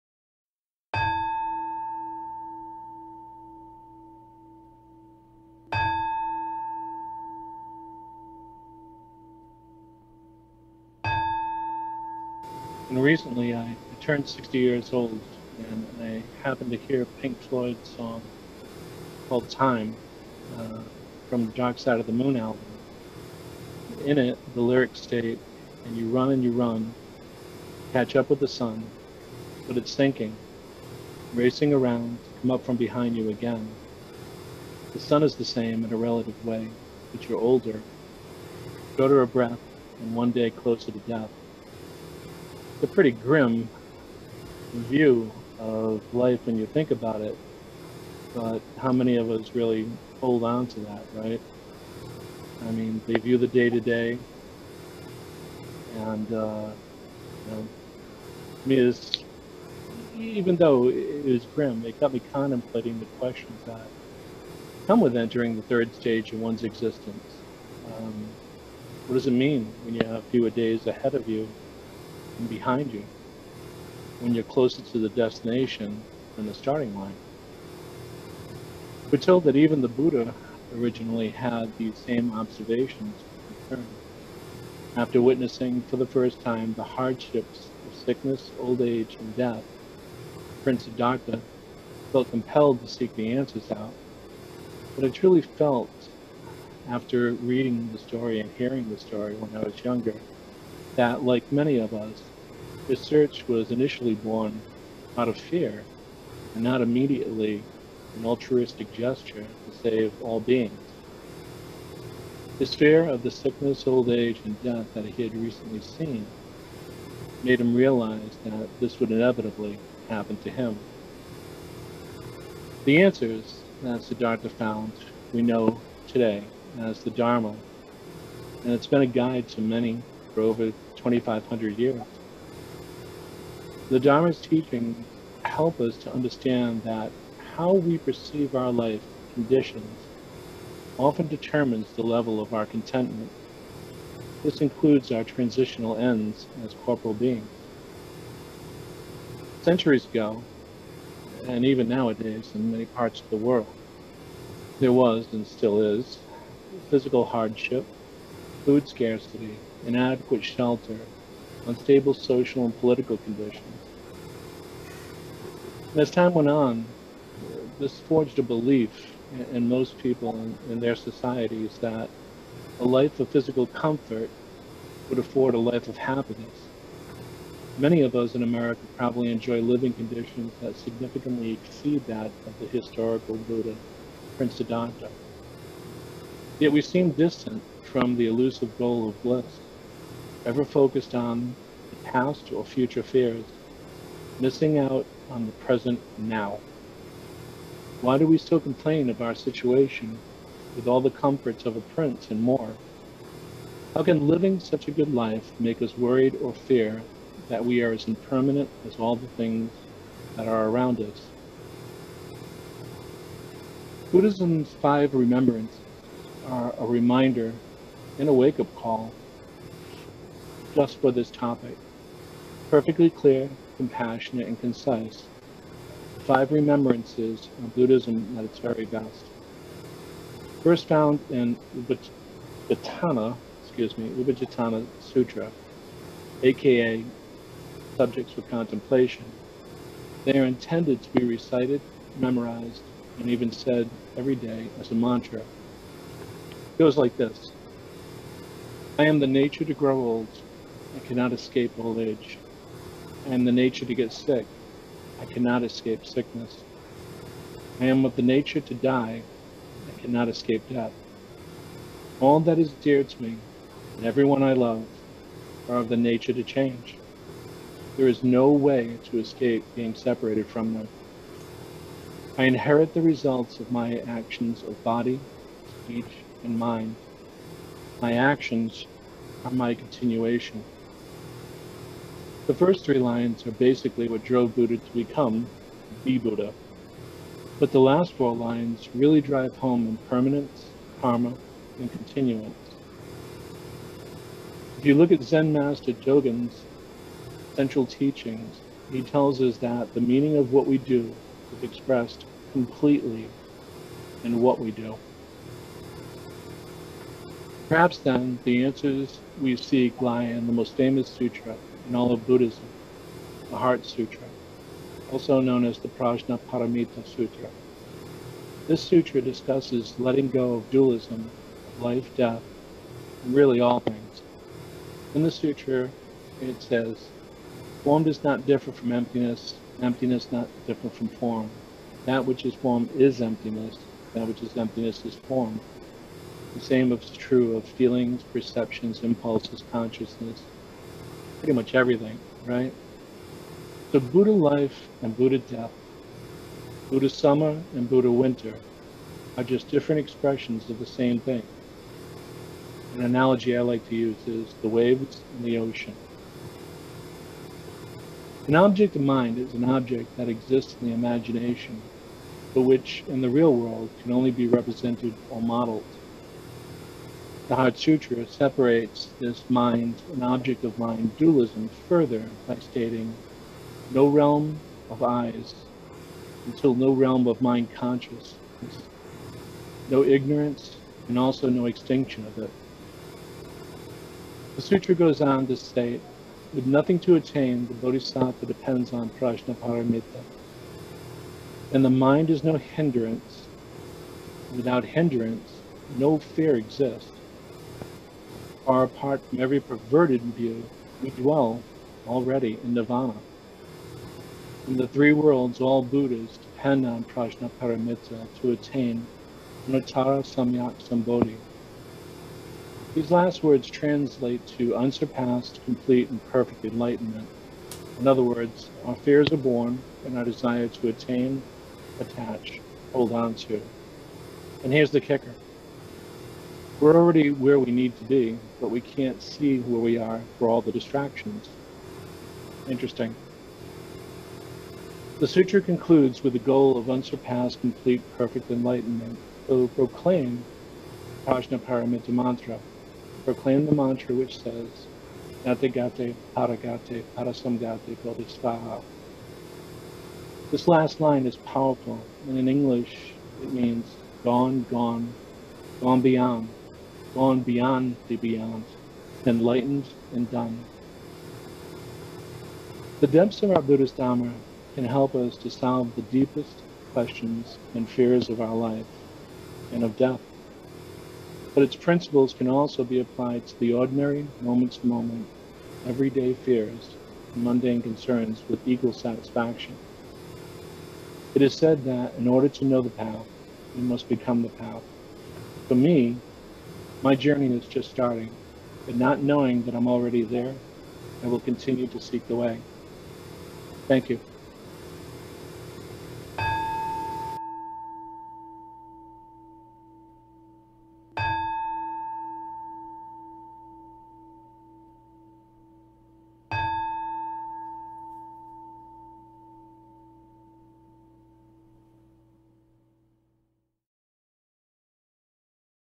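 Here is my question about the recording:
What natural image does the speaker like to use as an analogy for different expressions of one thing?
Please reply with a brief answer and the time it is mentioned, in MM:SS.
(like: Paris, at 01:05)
waves in the ocean, at 05:54.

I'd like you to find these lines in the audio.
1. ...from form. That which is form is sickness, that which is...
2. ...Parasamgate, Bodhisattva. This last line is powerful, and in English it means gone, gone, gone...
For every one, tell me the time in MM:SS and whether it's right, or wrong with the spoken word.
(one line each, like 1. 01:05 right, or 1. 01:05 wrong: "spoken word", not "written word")
1. 05:30 wrong: "emptiness", not "sickness"
2. 07:27 right.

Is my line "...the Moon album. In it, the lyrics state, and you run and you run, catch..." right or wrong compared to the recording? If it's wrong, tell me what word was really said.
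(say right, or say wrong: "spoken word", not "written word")
right.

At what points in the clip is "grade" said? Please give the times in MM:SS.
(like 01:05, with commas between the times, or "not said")
not said.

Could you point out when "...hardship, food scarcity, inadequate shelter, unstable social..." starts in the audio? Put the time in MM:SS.
02:37.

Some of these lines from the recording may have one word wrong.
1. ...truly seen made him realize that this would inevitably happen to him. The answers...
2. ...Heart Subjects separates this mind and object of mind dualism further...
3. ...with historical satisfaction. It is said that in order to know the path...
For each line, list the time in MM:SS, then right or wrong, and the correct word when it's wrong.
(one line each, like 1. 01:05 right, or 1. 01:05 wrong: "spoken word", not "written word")
1. 01:55 wrong: "recently", not "truly"
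2. 06:07 wrong: "Sutra", not "Subjects"
3. 07:58 wrong: "equal", not "historical".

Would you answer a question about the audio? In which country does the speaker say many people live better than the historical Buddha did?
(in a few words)
America.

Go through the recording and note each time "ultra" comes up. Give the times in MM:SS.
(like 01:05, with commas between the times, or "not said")
not said.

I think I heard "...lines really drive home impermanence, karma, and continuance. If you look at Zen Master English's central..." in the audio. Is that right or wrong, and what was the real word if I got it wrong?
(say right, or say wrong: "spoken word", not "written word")
wrong: "Dogen", not "English".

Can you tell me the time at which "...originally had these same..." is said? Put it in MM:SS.
01:20.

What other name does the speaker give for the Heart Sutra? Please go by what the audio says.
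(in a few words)
Prajna Paramita Sutra.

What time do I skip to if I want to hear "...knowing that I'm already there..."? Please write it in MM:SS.
08:09.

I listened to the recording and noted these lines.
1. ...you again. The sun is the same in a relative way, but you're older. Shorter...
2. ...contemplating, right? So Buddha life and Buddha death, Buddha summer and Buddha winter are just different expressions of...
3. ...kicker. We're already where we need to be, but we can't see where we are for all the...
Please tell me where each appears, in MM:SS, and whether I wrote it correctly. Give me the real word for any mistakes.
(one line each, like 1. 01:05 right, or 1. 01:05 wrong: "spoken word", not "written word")
1. 00:33 right
2. 05:41 wrong: "everything", not "contemplating"
3. 07:05 right.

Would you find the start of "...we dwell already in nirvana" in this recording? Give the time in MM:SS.
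06:41.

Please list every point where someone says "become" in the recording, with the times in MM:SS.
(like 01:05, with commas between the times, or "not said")
04:44, 08:04.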